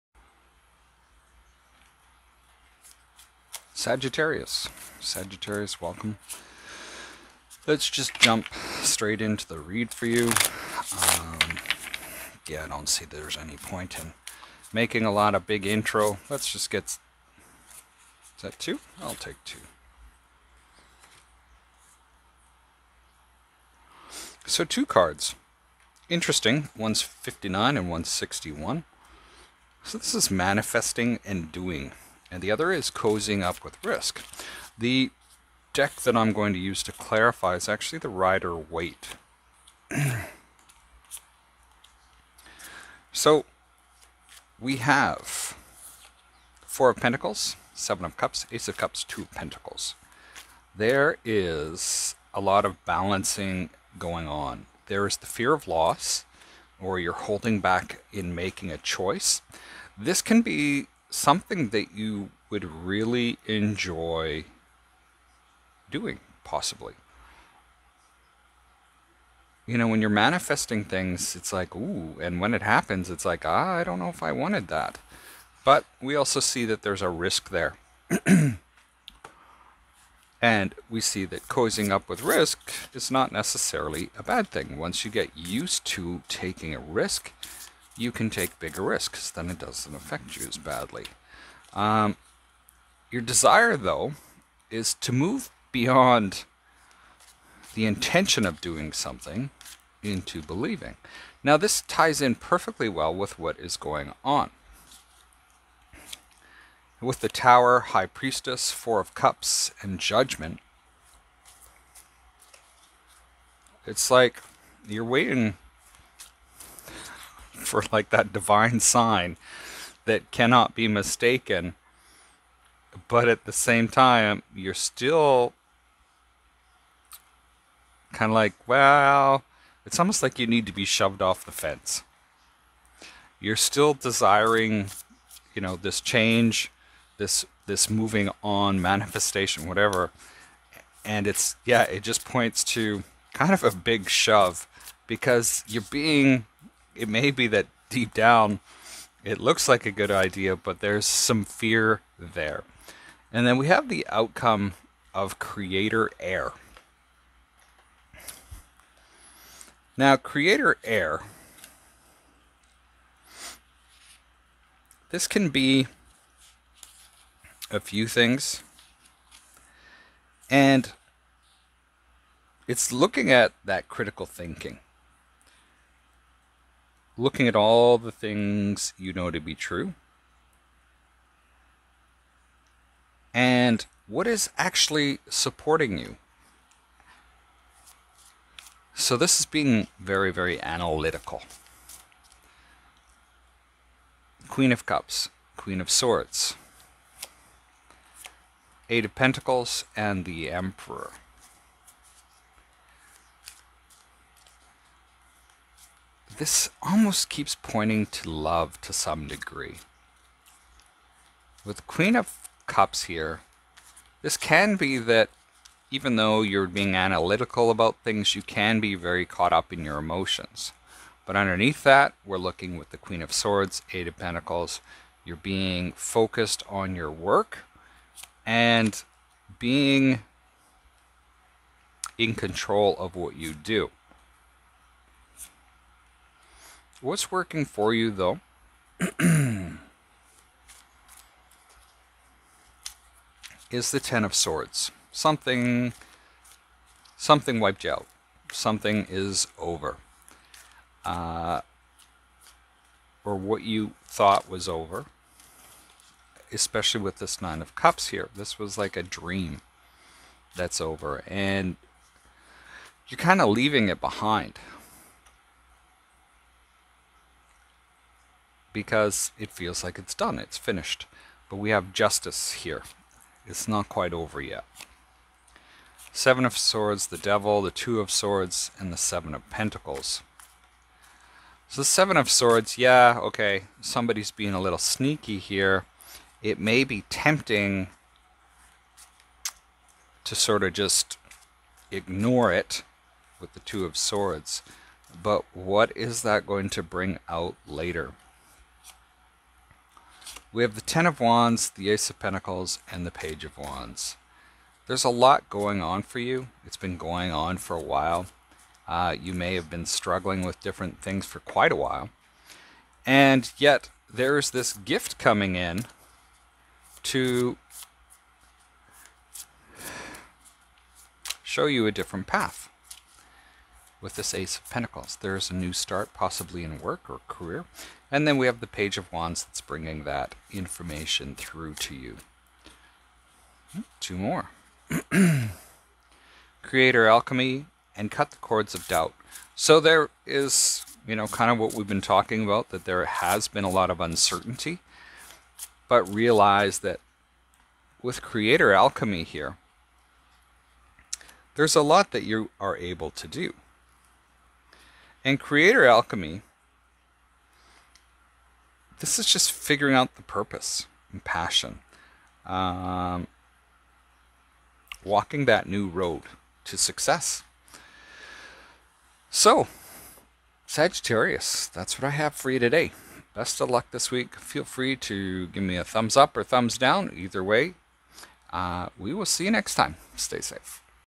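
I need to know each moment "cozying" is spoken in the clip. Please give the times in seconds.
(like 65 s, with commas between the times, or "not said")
32 s, 81 s.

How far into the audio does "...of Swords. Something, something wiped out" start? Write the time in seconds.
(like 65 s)
244 s.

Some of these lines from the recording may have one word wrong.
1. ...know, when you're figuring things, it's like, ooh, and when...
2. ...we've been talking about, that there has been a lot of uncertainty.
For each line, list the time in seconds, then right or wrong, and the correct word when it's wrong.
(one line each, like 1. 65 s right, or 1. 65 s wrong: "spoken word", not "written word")
1. 69 s wrong: "manifesting", not "figuring"
2. 341 s right.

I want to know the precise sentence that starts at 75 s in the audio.
But we also see that there's a risk there.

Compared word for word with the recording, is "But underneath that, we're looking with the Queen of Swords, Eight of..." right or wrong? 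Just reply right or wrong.
right.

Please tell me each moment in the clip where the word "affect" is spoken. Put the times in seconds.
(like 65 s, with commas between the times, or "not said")
89 s.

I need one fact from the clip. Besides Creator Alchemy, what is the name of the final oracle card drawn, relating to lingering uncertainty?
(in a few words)
Cut the Cords of Doubt.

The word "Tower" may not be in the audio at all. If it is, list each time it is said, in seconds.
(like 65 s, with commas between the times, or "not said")
107 s.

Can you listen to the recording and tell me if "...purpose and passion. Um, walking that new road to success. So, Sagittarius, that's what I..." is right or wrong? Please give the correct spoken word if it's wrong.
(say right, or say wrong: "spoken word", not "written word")
right.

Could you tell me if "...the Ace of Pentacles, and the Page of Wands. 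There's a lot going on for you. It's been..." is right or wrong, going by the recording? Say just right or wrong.
right.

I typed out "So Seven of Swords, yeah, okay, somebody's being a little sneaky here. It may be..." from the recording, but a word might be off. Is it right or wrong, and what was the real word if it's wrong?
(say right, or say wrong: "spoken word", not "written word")
right.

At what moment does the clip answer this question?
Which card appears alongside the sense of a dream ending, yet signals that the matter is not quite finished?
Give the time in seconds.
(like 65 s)
271 s.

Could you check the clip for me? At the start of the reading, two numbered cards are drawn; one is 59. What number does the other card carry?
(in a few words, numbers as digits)
61.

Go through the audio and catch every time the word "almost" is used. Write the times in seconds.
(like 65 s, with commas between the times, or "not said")
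129 s, 206 s.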